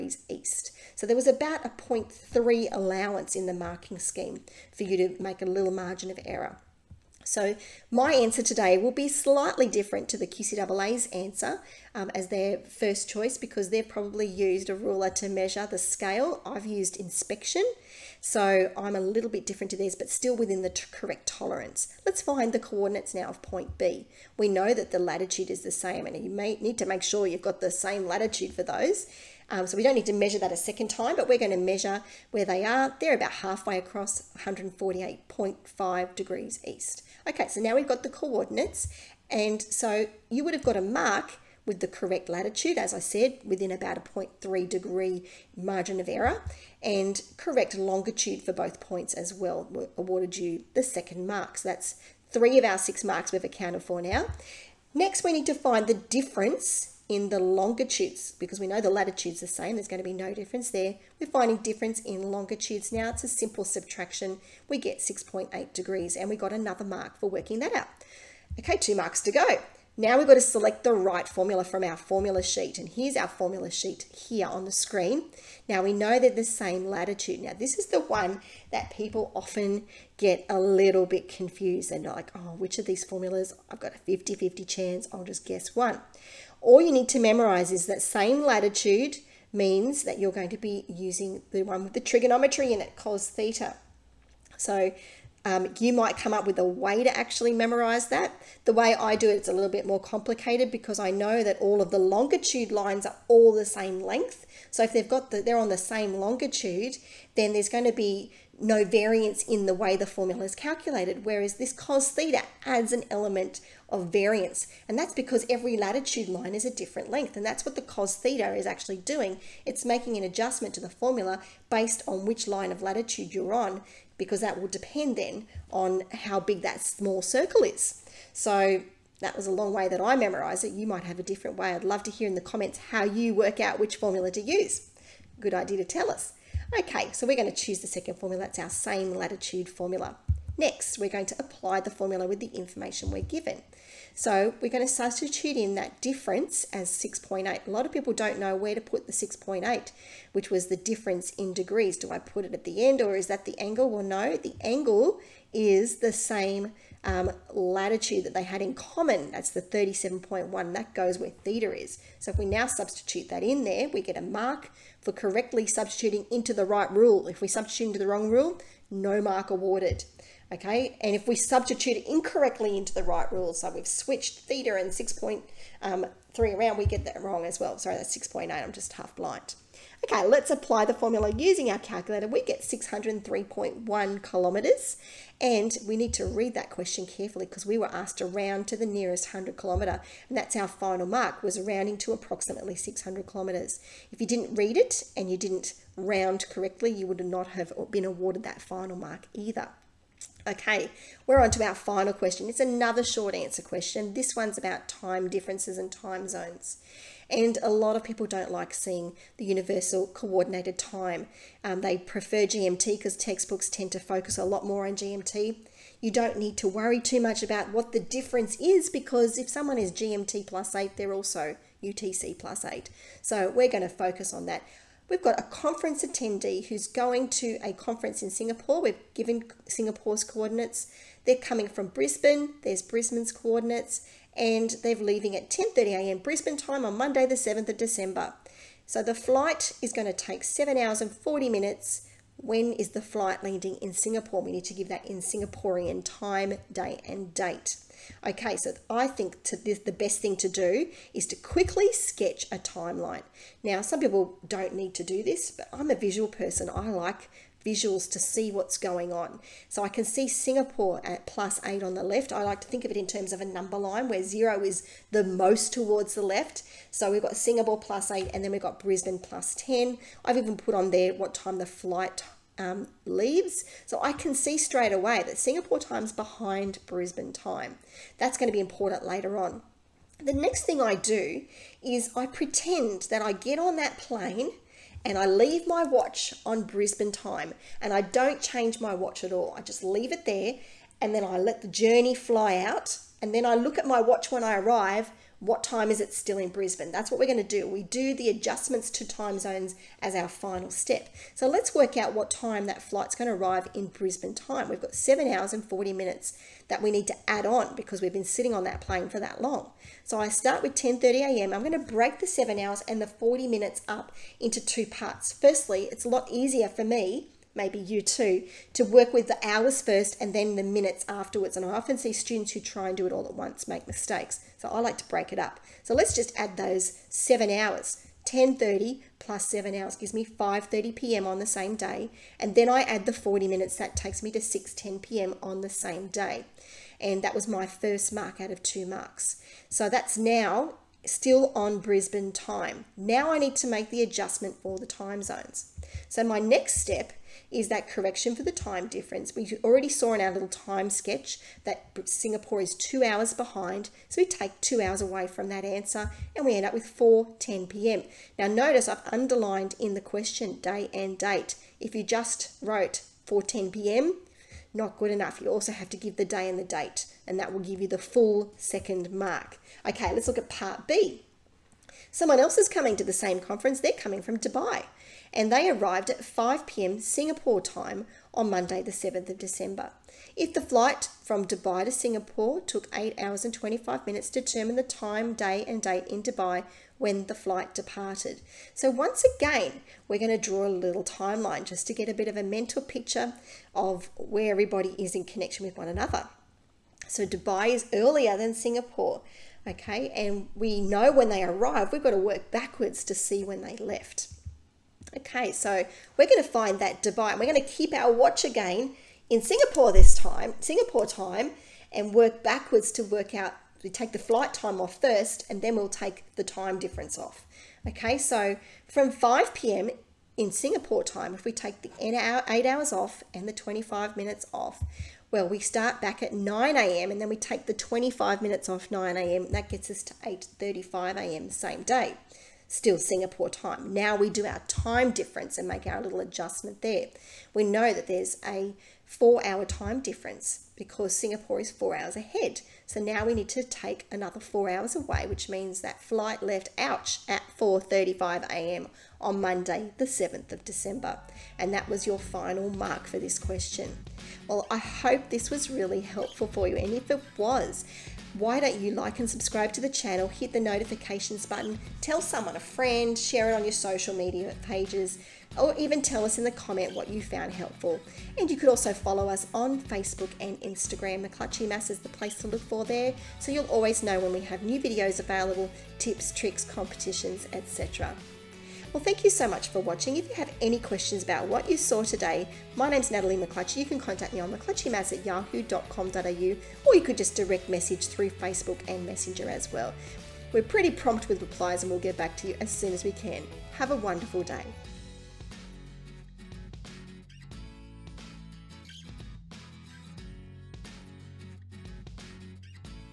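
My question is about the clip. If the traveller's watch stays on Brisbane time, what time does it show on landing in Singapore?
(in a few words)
6:10 p.m.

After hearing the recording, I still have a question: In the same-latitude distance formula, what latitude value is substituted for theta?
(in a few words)
37.1.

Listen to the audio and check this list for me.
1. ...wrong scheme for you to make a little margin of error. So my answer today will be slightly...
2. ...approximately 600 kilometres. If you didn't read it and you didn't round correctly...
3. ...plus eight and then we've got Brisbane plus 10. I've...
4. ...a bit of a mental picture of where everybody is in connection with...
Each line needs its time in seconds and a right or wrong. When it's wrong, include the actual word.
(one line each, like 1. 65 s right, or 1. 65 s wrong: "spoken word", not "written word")
1. 3 s wrong: "marking", not "wrong"
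2. 192 s right
3. 267 s right
4. 392 s right.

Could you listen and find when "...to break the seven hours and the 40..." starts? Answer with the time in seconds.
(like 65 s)
311 s.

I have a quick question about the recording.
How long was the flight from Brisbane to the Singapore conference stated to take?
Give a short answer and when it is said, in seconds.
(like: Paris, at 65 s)
7 hours 40 minutes, at 240 s.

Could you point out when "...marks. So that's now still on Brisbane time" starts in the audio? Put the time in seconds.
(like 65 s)
338 s.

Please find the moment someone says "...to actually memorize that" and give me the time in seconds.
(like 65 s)
97 s.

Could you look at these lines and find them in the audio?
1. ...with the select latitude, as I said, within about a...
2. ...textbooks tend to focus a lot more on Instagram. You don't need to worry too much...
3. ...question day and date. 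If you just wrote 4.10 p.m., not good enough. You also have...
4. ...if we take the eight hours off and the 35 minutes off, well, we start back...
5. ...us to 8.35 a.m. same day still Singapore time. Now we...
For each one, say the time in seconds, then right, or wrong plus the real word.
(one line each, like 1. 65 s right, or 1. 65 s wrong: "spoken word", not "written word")
1. 41 s wrong: "correct", not "select"
2. 213 s wrong: "GMT", not "Instagram"
3. 359 s right
4. 421 s wrong: "25", not "35"
5. 429 s right.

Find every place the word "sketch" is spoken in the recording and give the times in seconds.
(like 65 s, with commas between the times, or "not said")
251 s, 350 s.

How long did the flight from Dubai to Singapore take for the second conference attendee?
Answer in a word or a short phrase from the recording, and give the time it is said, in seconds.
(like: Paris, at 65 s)
8 hours 25 minutes, at 382 s.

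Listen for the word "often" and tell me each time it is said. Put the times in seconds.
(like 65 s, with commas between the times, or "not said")
79 s, 321 s.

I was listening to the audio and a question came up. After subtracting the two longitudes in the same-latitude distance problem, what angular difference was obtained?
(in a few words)
6.8 degrees.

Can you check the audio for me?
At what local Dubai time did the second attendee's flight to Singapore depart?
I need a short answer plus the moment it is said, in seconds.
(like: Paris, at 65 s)
4:35 a.m., at 447 s.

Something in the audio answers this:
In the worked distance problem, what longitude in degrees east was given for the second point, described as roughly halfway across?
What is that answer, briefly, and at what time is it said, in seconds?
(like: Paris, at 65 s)
148.5 degrees east, at 34 s.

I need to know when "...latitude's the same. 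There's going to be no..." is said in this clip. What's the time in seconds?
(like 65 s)
58 s.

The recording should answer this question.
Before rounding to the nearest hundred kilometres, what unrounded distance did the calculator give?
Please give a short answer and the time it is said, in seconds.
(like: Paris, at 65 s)
603.1 kilometres, at 182 s.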